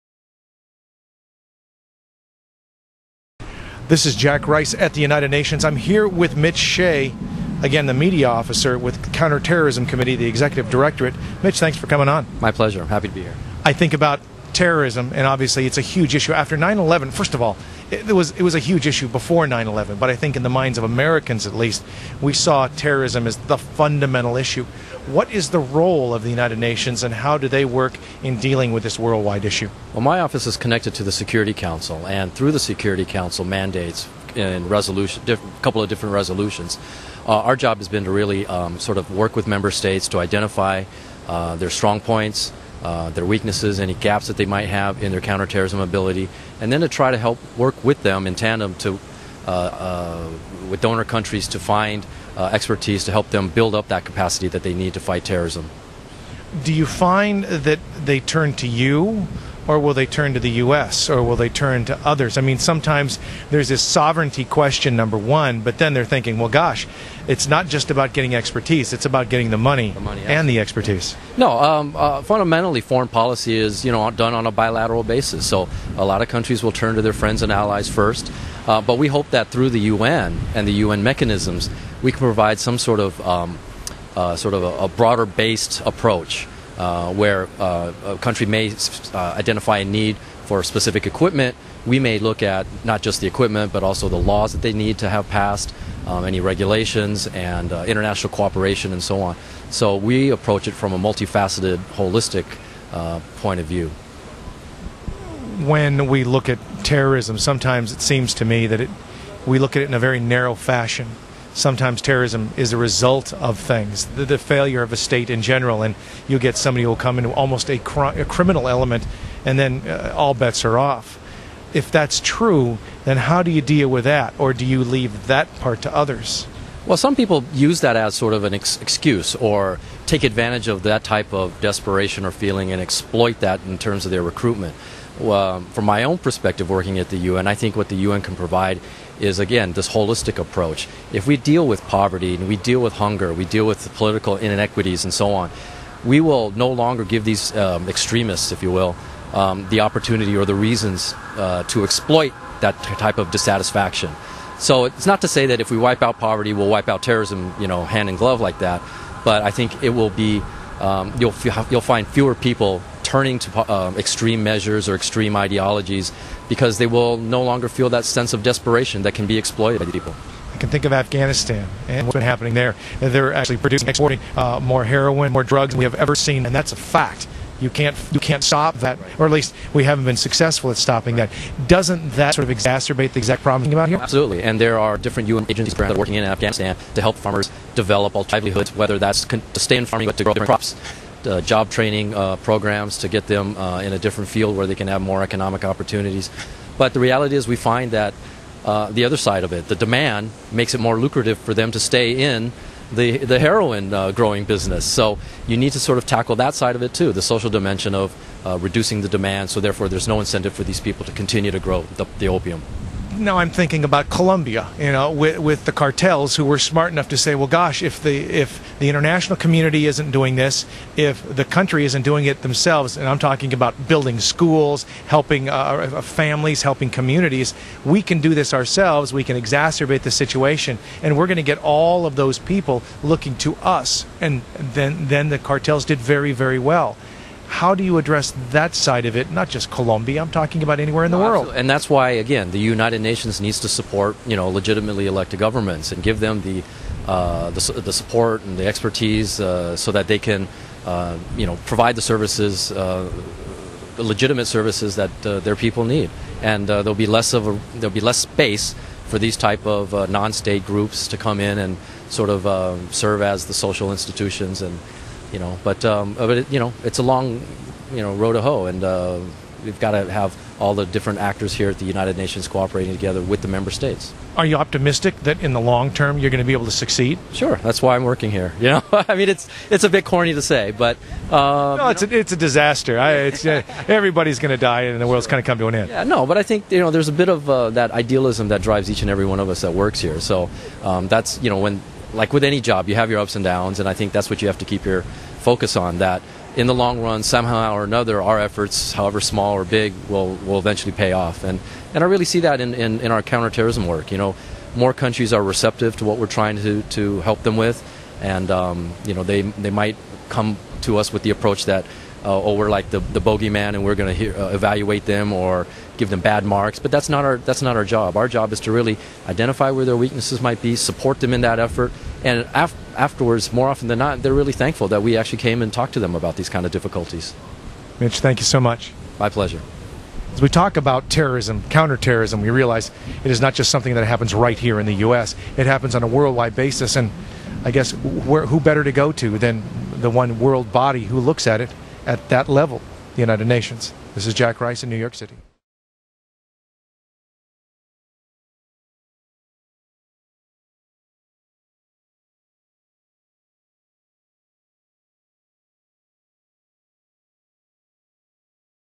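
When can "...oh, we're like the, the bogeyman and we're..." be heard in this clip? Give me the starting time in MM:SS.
05:12.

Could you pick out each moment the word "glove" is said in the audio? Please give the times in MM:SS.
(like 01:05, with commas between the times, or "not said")
02:38.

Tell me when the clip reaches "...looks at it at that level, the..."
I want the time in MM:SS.
05:41.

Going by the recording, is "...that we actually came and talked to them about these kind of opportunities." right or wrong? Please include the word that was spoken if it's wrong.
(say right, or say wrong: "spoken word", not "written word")
wrong: "difficulties", not "opportunities".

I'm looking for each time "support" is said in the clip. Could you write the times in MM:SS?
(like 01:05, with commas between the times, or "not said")
04:03, 04:07, 05:20.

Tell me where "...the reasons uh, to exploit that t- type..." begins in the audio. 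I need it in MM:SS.
02:30.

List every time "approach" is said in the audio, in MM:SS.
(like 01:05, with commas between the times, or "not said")
01:25, 01:40, 02:20, 05:11.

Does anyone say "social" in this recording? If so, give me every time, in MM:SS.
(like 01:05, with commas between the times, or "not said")
03:27, 04:23.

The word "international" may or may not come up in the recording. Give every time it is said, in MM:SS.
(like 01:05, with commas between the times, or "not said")
01:37, 03:38.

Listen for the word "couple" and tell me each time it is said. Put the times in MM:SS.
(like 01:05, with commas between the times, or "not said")
00:35.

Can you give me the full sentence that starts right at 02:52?
They're actually producing, exporting uh, more heroin, more drugs than we have ever seen, and that's a fact.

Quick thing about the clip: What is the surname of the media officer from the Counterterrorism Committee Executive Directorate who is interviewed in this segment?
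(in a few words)
Hsieh.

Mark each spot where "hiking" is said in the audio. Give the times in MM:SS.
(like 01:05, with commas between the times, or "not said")
not said.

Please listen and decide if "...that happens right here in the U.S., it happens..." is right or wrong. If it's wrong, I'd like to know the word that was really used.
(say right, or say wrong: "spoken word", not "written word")
right.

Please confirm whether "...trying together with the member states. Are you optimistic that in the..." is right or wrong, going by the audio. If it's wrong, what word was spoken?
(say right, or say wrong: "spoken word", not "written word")
wrong: "cooperating", not "trying".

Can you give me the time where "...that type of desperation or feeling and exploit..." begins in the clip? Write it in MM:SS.
02:10.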